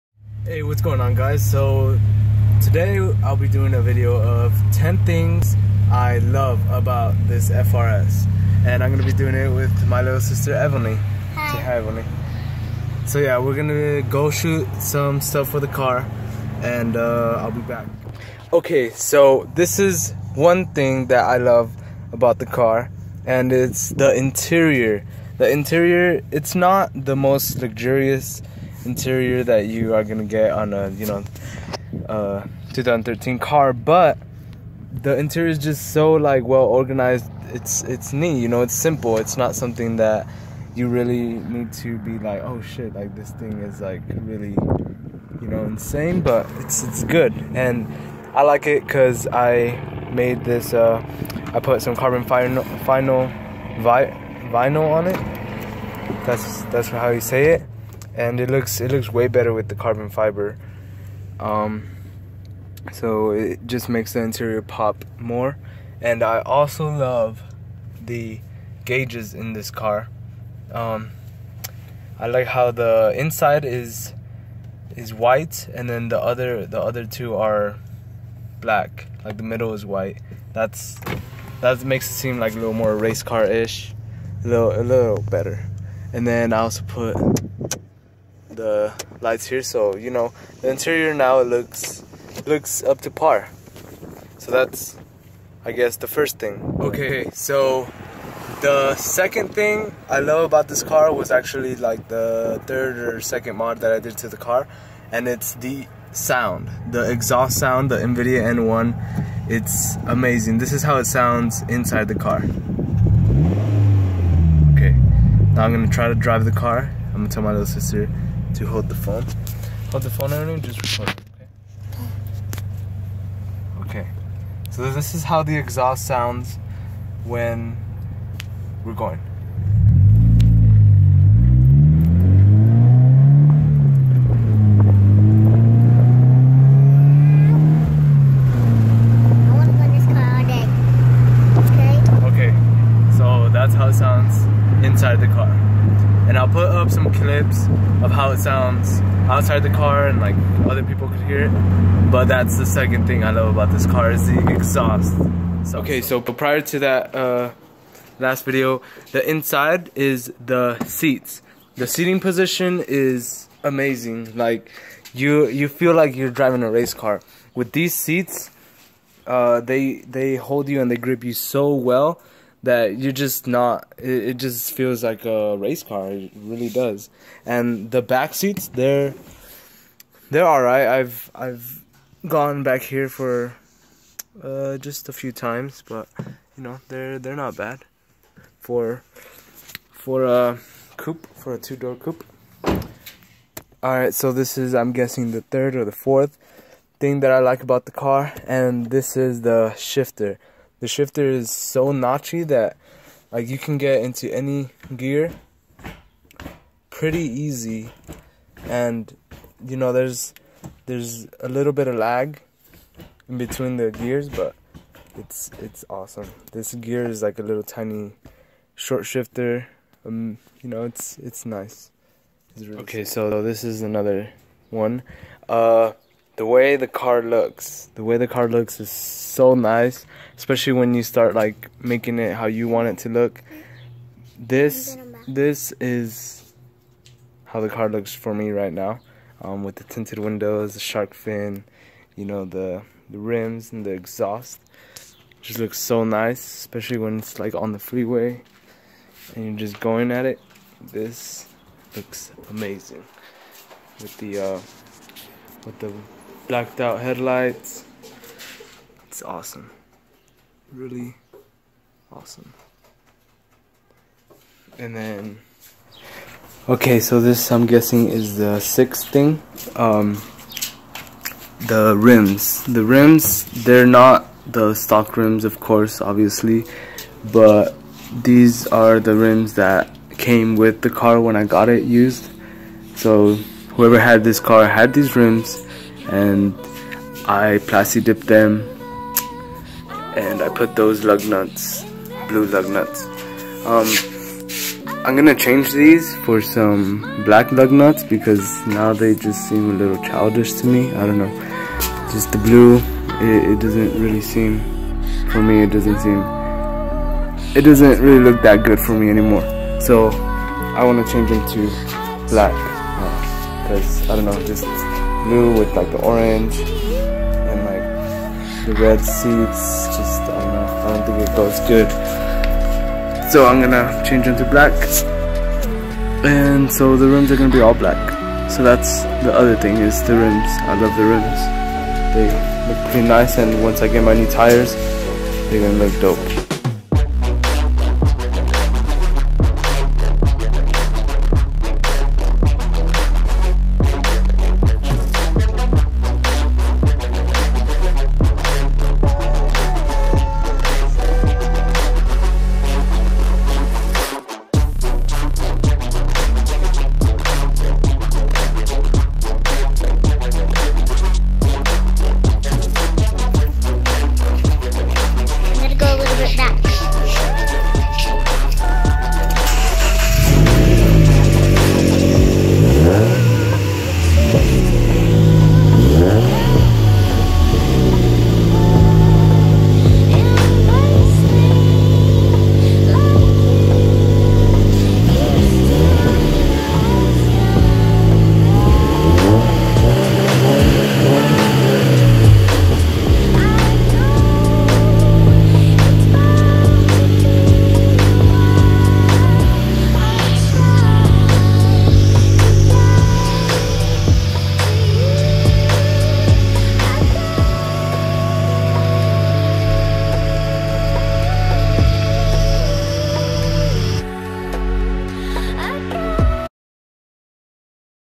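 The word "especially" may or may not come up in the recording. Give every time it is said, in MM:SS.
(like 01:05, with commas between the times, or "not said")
03:50, 04:06.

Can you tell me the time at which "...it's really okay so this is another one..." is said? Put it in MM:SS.
03:42.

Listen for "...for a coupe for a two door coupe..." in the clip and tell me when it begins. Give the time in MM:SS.
03:09.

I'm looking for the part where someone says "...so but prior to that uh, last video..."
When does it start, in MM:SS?
02:36.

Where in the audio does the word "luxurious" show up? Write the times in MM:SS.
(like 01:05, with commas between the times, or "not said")
00:27.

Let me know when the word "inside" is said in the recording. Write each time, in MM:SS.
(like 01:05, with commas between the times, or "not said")
01:13, 01:51, 02:24, 02:39.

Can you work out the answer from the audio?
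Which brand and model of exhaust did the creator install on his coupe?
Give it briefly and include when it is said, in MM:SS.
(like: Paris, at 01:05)
Invidia N1, at 01:47.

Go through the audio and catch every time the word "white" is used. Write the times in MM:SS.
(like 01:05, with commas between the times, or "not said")
01:15, 01:19.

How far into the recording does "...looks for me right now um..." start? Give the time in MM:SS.
03:57.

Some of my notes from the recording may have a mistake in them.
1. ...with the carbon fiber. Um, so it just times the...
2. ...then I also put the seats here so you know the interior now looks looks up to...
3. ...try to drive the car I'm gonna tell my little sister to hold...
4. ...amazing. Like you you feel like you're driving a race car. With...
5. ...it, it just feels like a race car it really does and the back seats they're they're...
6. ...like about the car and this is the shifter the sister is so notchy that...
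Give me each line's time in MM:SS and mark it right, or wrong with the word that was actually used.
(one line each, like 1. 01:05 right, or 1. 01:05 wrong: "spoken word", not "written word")
1. 00:59 wrong: "makes", not "times"
2. 01:26 wrong: "lights", not "seats"
3. 01:55 right
4. 02:43 right
5. 02:53 right
6. 03:17 wrong: "shifter", not "sister".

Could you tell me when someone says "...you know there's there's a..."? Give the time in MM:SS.
03:29.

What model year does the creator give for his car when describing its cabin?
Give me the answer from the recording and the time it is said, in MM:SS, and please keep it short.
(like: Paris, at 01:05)
2013, at 00:32.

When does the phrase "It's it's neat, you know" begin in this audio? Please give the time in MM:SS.
00:37.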